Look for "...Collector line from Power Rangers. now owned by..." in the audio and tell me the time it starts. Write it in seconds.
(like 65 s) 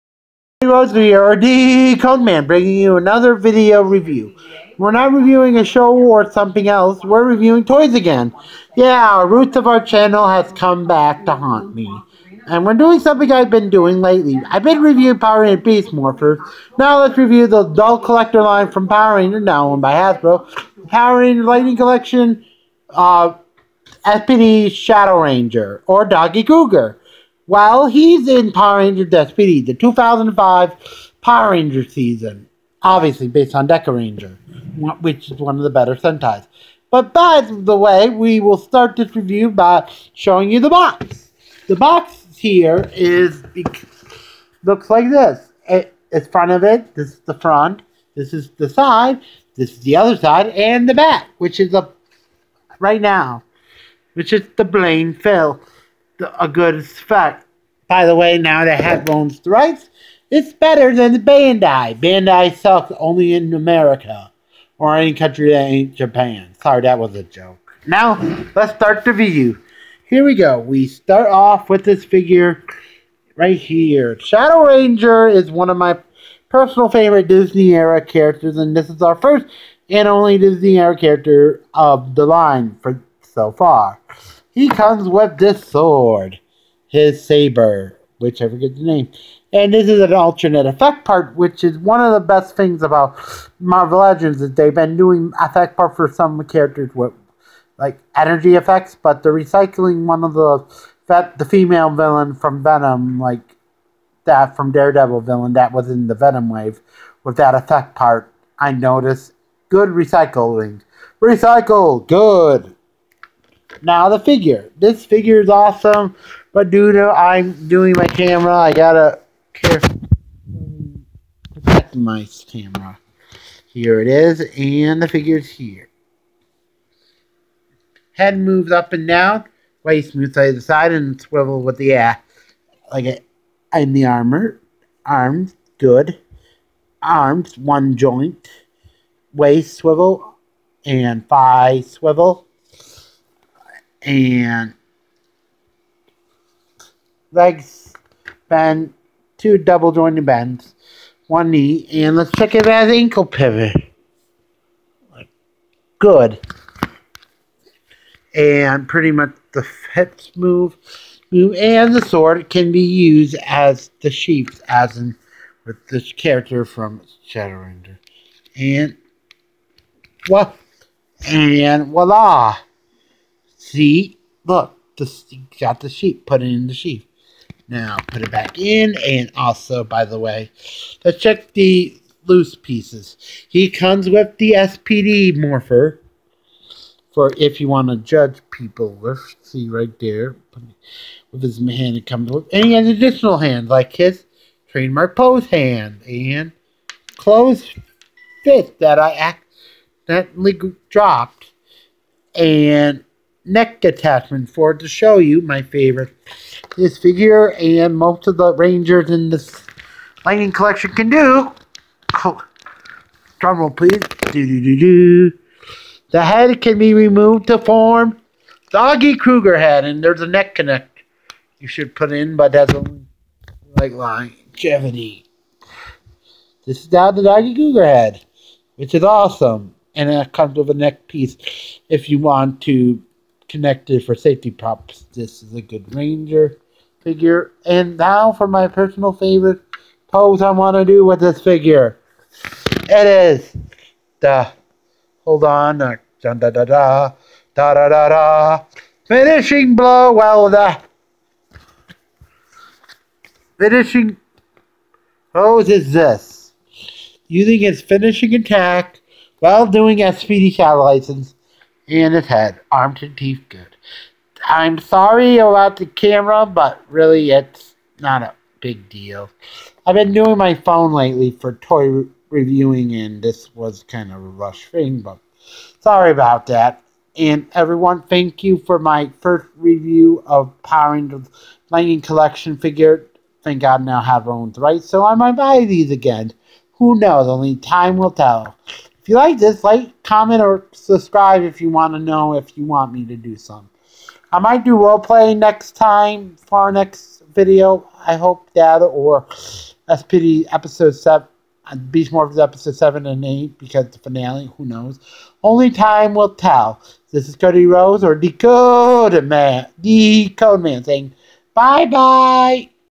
17 s.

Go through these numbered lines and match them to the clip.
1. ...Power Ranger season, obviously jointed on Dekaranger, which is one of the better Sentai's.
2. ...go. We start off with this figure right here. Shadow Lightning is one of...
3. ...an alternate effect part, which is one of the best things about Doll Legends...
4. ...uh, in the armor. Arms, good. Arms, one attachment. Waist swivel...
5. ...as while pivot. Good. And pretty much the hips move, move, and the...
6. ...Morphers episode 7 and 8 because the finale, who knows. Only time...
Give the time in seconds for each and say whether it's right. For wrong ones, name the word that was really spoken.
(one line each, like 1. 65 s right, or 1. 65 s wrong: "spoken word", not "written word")
1. 31 s wrong: "based", not "jointed"
2. 70 s wrong: "Ranger", not "Lightning"
3. 90 s wrong: "Marvel", not "Doll"
4. 133 s wrong: "joint", not "attachment"
5. 152 s wrong: "ankle", not "while"
6. 302 s right.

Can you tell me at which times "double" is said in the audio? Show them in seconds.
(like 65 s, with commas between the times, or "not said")
149 s.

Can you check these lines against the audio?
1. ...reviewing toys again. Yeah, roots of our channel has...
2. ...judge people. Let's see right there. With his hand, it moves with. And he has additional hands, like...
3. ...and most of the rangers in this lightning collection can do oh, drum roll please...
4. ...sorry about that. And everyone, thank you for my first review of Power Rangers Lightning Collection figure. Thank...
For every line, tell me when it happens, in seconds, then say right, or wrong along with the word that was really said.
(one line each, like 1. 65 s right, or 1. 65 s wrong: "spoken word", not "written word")
1. 7 s right
2. 187 s wrong: "comes", not "moves"
3. 207 s right
4. 275 s right.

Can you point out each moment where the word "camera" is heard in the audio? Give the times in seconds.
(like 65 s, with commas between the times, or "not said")
118 s, 122 s, 265 s.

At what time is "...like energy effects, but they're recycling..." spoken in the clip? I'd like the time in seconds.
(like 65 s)
97 s.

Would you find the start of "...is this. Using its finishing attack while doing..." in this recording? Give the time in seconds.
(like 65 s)
255 s.